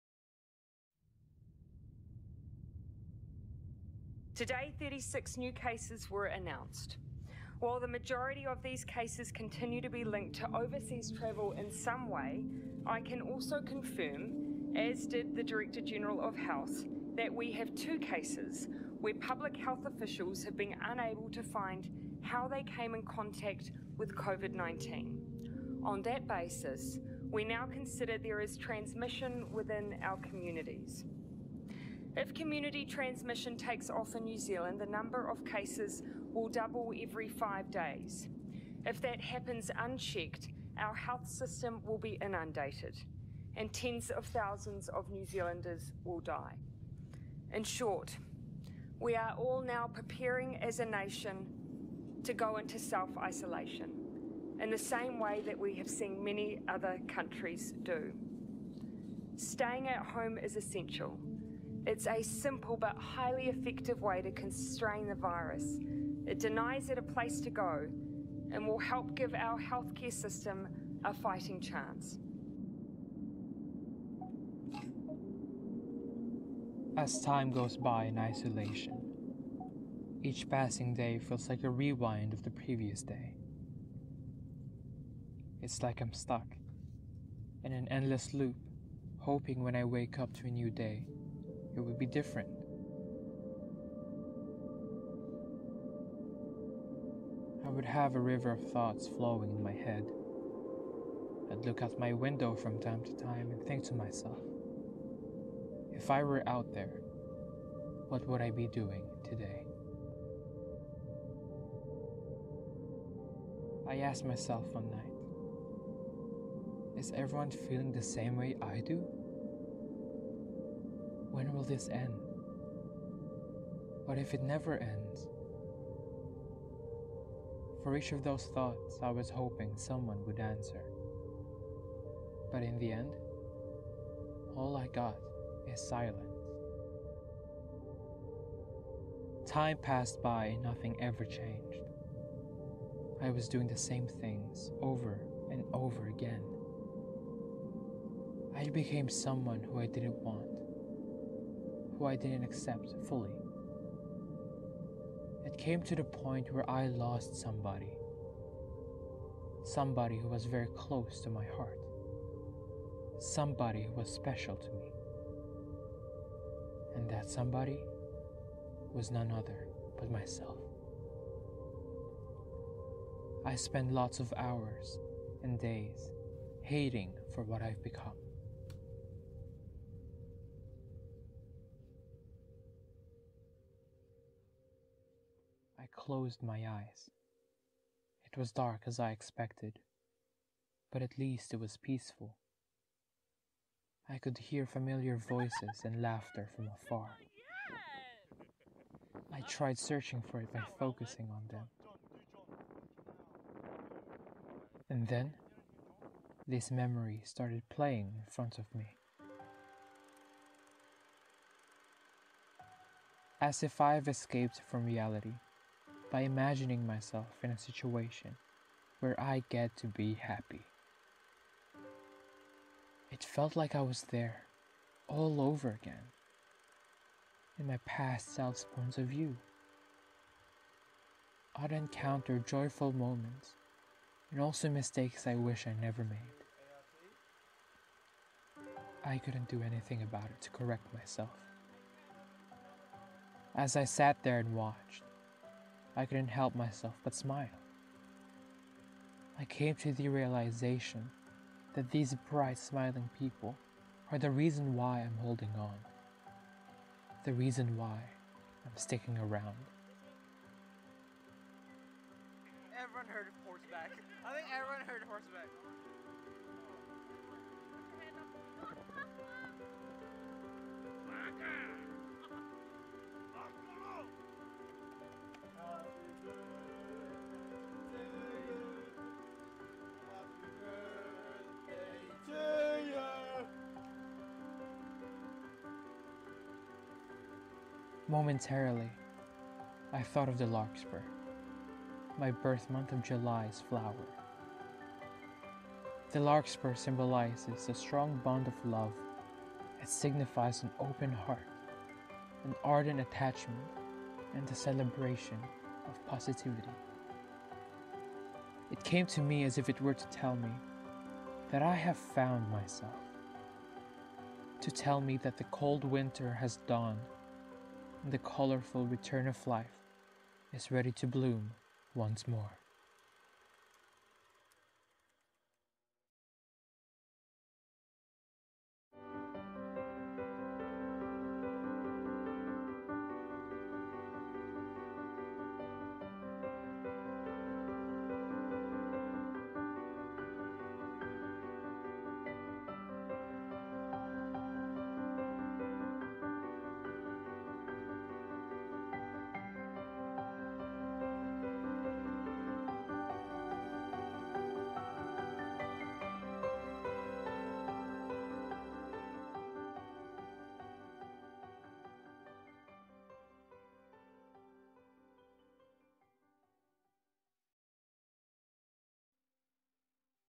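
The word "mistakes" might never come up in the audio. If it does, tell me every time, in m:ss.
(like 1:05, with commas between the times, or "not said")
3:54.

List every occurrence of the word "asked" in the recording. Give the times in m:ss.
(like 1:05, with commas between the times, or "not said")
1:53.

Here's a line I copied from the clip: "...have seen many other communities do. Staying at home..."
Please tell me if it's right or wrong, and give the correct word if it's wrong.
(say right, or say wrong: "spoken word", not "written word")
wrong: "countries", not "communities".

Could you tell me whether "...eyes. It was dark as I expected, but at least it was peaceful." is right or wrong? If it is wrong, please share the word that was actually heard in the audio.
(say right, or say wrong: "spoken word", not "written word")
right.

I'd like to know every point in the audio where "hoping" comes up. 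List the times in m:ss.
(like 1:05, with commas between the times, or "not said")
1:29, 2:09.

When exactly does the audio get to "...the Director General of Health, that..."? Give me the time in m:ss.
0:15.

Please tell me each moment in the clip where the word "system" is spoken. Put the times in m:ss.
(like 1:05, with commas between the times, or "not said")
0:41, 1:10.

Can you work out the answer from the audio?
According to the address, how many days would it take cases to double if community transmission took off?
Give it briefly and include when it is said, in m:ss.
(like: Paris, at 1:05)
5, at 0:37.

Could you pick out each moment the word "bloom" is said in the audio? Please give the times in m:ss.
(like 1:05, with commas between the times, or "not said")
5:21.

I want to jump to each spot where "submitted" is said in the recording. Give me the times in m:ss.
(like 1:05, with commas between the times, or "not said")
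not said.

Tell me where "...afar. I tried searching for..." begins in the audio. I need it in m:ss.
3:16.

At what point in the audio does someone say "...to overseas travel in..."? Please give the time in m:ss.
0:10.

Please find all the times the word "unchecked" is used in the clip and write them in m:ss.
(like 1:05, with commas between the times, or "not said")
0:39.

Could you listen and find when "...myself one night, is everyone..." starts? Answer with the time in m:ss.
1:54.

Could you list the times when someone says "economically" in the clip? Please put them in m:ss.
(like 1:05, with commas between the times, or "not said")
not said.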